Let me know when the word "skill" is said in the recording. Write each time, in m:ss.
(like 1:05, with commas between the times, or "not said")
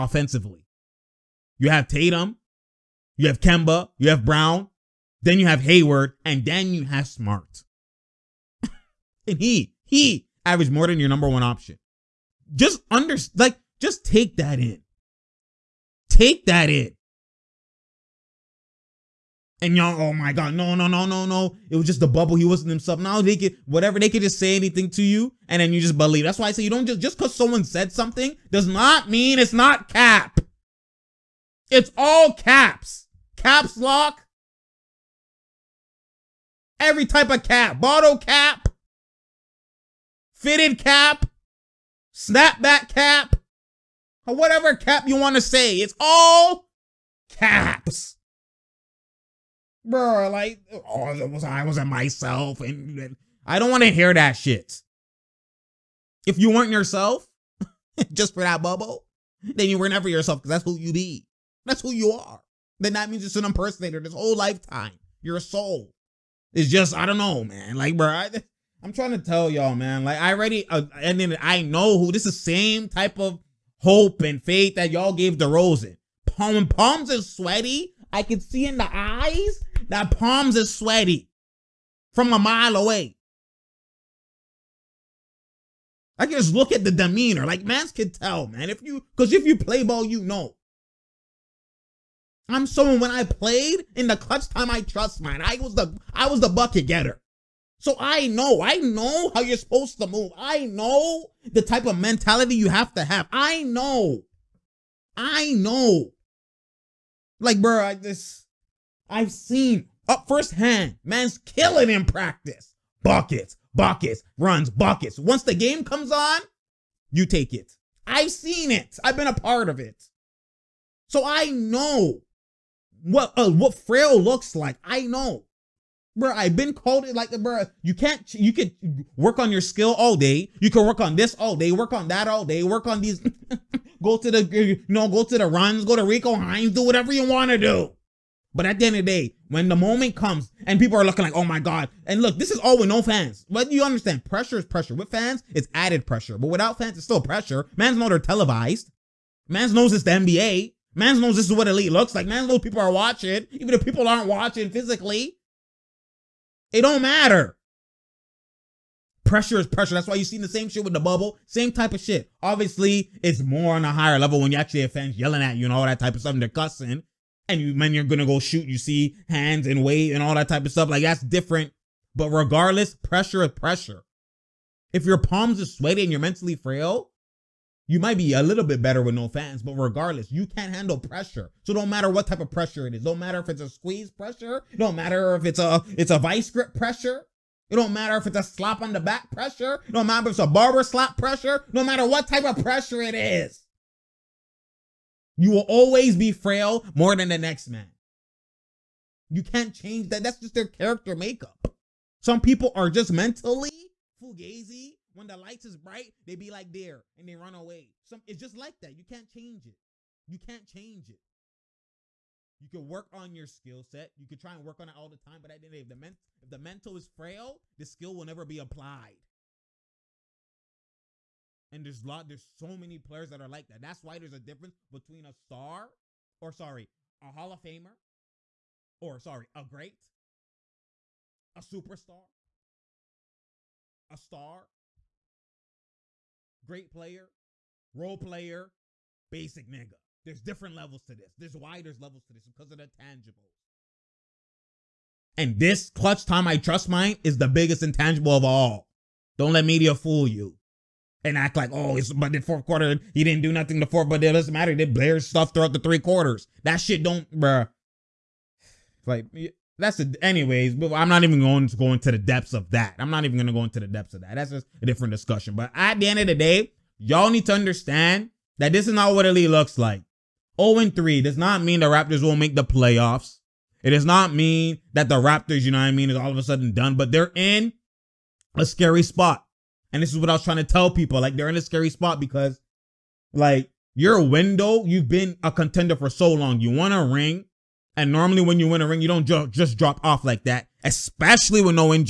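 2:09, 3:33, 3:37.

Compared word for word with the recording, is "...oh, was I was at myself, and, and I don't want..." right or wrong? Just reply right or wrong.
right.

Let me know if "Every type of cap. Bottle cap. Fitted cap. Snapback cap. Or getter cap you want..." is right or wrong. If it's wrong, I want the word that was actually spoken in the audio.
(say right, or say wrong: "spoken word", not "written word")
wrong: "whatever", not "getter".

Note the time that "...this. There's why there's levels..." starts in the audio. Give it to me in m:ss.
4:01.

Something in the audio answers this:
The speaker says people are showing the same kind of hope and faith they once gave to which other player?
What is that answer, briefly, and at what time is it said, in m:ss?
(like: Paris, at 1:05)
DeRozan, at 1:15.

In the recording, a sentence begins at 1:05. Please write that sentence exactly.
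Your soul is just, I don't know, man.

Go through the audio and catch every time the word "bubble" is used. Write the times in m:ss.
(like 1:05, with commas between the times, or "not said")
0:22, 0:58, 2:40.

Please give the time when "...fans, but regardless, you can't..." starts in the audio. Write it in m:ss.
2:59.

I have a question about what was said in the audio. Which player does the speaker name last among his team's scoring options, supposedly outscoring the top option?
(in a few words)
Smart.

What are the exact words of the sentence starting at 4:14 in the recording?
They did stuff throughout the three quarters.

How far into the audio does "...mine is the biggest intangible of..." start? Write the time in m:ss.
4:06.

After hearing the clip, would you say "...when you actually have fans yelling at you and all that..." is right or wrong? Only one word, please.
right.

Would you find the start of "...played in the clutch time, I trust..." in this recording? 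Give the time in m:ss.
1:33.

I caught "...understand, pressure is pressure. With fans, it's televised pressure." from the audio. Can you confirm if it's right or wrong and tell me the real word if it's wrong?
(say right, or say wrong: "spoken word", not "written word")
wrong: "added", not "televised".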